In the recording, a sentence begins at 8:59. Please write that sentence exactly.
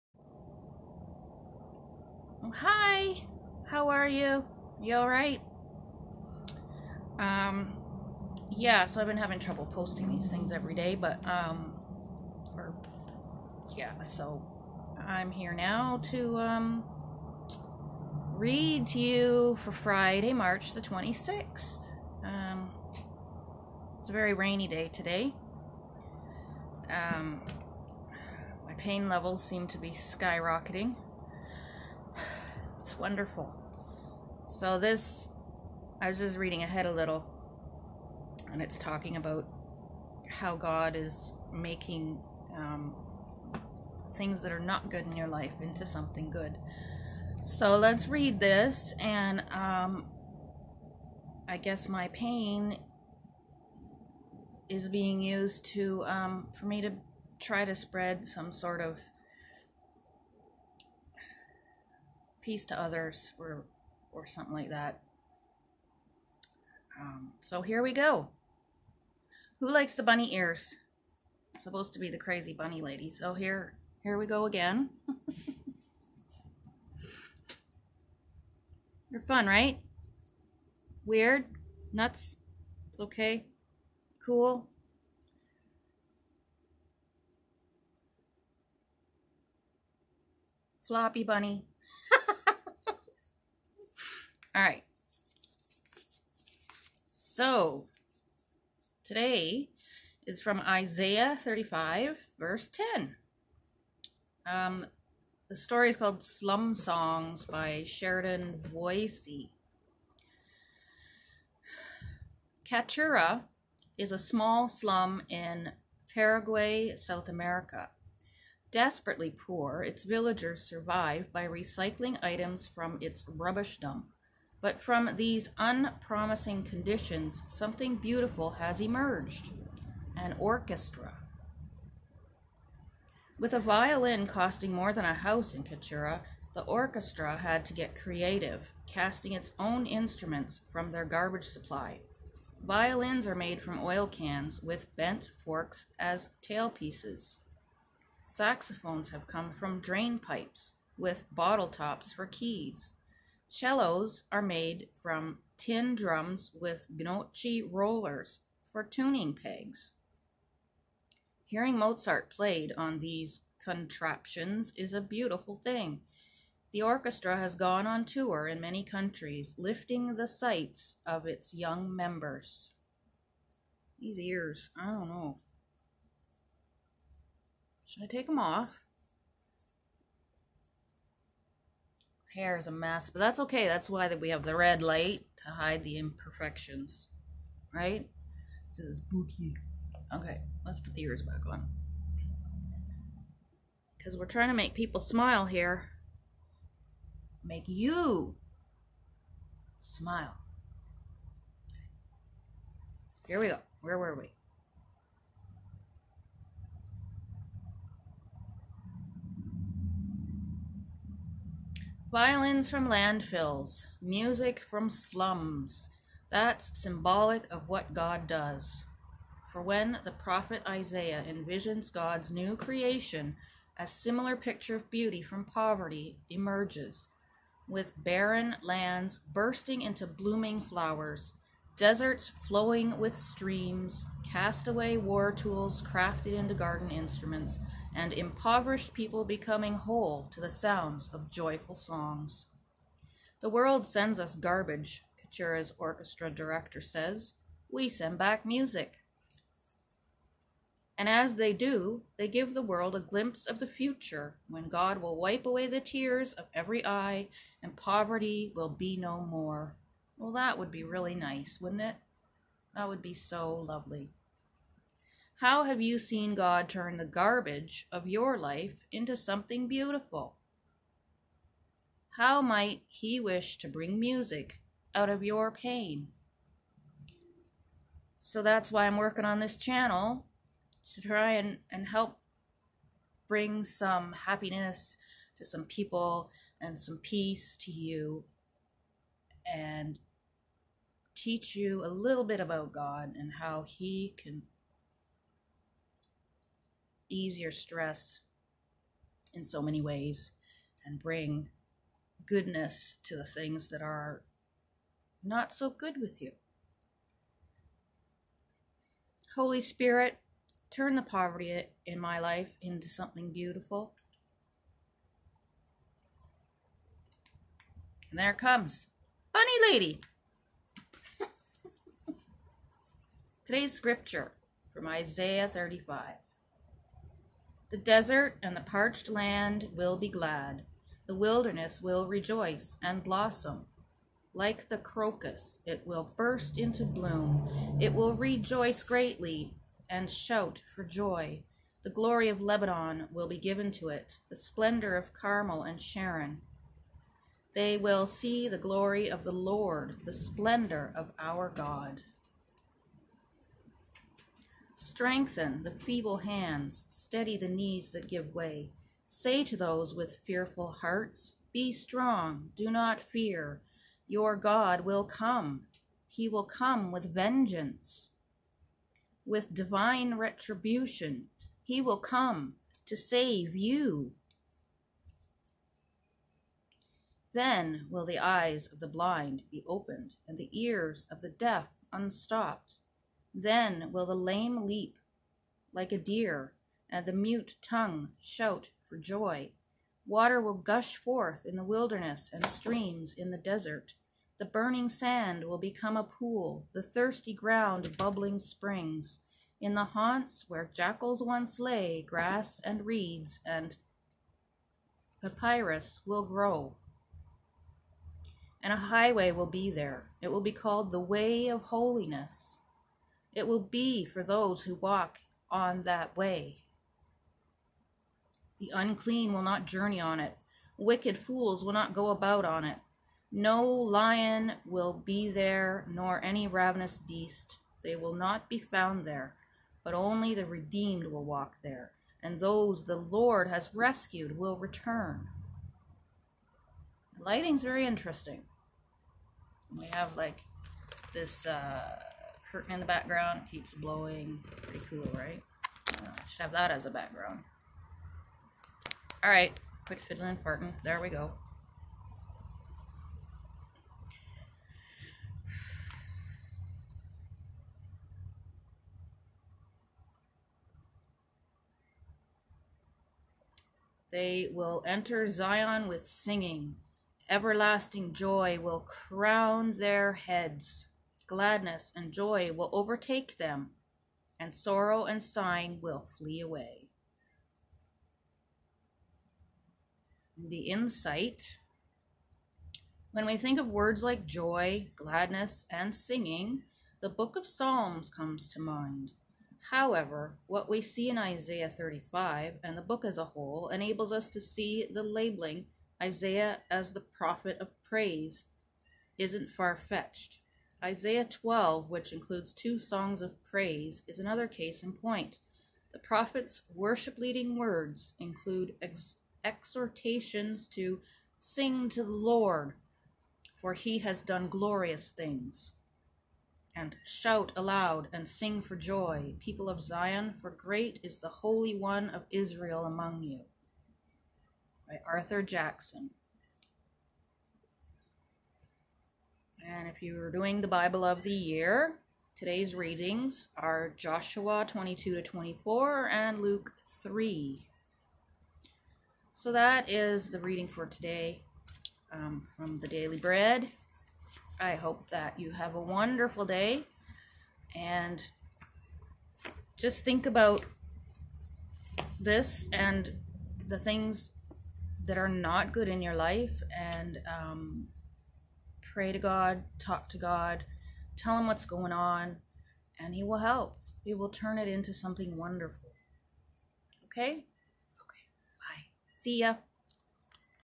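So that is the reading for today um, from the Daily Bread.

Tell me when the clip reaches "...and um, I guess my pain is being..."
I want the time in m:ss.
0:48.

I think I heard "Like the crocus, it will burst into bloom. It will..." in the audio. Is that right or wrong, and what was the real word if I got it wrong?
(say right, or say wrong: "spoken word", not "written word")
right.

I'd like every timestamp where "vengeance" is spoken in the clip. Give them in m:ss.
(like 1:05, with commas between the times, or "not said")
6:07.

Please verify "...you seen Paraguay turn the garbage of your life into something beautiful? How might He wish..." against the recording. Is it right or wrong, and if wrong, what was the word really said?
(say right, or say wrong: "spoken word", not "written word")
wrong: "God", not "Paraguay".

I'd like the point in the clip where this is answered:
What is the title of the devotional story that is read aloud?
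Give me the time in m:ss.
1:46.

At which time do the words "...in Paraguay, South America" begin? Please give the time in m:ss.
1:55.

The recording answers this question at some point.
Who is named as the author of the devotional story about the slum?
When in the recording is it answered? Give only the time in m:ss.
1:47.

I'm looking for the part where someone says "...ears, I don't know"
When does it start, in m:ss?
2:54.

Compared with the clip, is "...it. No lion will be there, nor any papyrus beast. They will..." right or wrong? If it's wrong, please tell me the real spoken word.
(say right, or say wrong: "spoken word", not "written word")
wrong: "ravenous", not "papyrus".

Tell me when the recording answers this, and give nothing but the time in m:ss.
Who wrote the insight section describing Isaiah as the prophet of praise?
8:45.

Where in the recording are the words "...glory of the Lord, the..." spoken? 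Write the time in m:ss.
5:48.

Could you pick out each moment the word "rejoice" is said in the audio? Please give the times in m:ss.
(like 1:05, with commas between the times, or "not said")
5:32, 5:38.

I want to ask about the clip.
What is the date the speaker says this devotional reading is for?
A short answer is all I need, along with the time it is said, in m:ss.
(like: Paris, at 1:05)
Friday, March 26, at 0:19.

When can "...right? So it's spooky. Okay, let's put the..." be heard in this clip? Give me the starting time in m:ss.
3:07.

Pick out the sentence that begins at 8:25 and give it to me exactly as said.
The prophet's worship leading words include ex- exhortations to sing to the Lord, for he has done glorious things.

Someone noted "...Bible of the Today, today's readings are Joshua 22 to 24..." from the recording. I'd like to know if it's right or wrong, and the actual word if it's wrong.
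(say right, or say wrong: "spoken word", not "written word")
wrong: "Year", not "Today".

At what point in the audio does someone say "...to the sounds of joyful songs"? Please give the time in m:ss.
4:00.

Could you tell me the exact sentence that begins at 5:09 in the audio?
Holy Spirit, turn the poverty in my life into something beautiful.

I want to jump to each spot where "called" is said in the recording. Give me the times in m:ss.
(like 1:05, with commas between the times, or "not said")
1:45, 6:50.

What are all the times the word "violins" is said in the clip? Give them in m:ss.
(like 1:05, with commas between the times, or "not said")
2:13, 2:22, 3:32.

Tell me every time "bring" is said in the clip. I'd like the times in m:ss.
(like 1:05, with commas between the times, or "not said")
4:33, 4:43, 5:00.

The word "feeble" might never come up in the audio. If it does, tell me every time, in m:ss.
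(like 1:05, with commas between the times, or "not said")
5:55.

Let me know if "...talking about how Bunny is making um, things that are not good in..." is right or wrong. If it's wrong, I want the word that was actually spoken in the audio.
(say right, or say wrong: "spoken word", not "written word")
wrong: "God", not "Bunny".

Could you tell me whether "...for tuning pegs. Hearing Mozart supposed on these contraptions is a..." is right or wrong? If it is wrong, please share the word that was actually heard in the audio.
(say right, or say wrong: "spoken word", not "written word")
wrong: "played", not "supposed".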